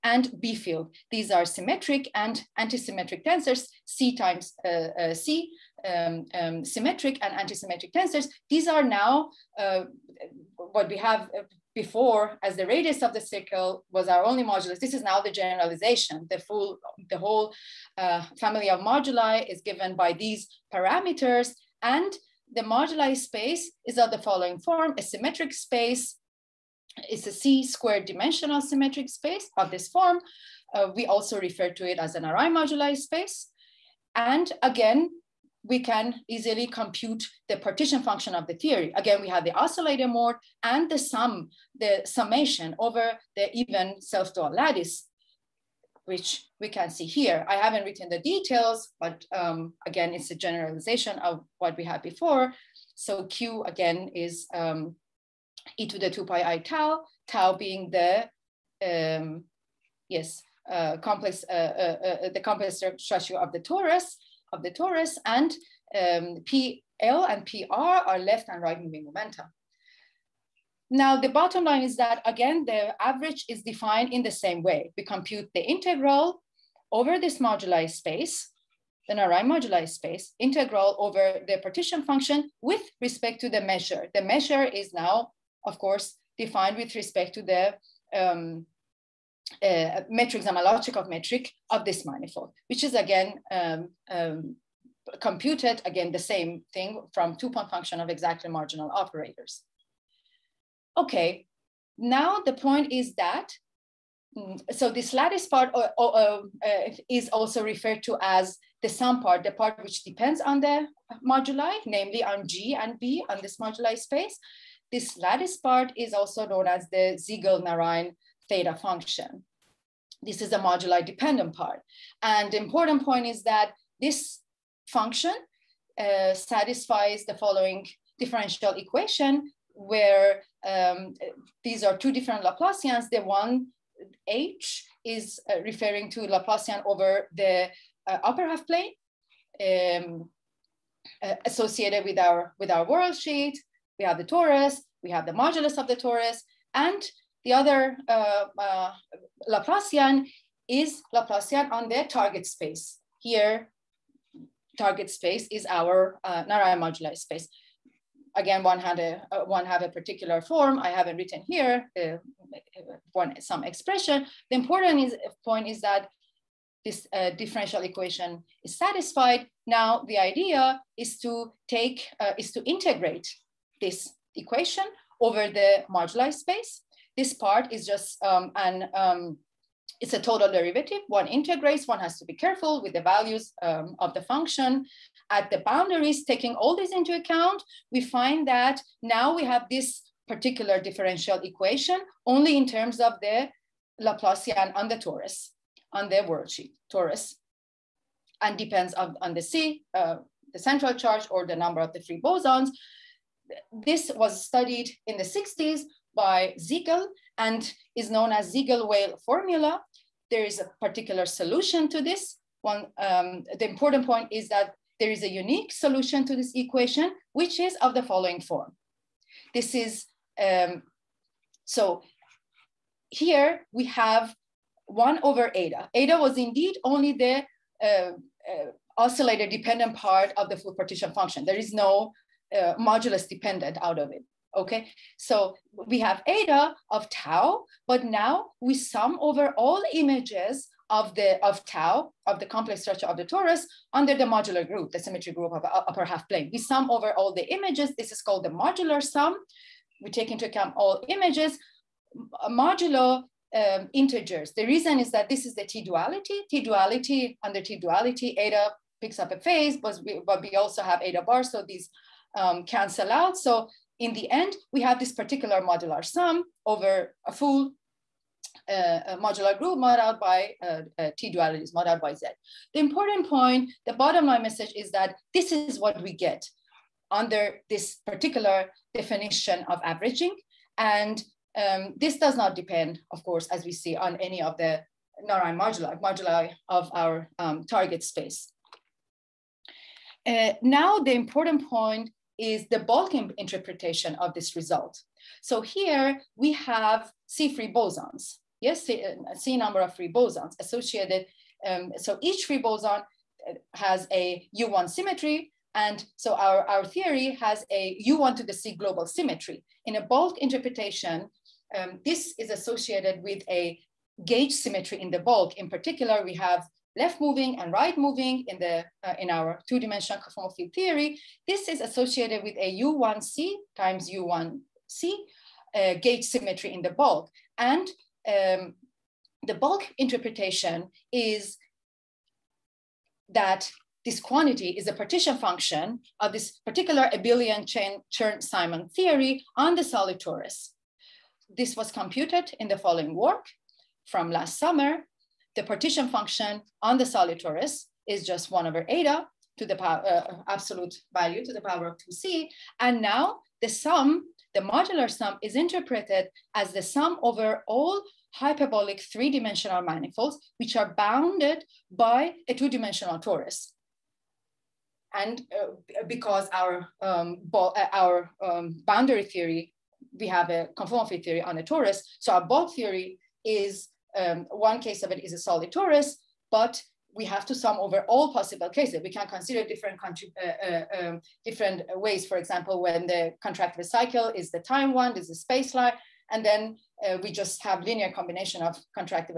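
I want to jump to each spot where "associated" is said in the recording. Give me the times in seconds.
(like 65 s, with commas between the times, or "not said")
141 s, 300 s, 312 s, 321 s.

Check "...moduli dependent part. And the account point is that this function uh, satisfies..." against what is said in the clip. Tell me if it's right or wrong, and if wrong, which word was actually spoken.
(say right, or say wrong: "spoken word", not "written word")
wrong: "important", not "account".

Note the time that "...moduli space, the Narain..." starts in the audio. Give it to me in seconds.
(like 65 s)
77 s.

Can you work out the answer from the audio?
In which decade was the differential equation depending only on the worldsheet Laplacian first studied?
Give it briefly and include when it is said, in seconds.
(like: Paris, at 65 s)
1960s, at 205 s.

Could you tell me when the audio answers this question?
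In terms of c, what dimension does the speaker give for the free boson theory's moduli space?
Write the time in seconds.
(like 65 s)
27 s.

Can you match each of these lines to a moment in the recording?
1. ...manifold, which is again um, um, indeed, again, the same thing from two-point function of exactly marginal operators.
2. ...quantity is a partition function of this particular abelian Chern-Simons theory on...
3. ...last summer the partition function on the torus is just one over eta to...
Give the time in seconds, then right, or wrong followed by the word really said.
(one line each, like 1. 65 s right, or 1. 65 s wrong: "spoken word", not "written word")
1. 92 s wrong: "computed", not "indeed"
2. 334 s right
3. 344 s right.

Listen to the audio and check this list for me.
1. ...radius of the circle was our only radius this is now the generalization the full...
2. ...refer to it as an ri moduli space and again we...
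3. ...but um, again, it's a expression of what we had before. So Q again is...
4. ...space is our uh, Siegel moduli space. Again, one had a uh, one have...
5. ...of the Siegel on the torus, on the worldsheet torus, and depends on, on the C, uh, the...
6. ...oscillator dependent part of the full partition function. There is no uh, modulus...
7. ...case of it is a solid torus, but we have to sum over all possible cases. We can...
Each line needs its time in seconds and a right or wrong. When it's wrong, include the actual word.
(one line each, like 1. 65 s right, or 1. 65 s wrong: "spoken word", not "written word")
1. 12 s wrong: "modulus", not "radius"
2. 31 s right
3. 49 s wrong: "generalization", not "expression"
4. 155 s wrong: "Narain", not "Siegel"
5. 193 s wrong: "Laplacian", not "Siegel"
6. 228 s right
7. 374 s right.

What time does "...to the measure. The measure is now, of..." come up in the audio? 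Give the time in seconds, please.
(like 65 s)
83 s.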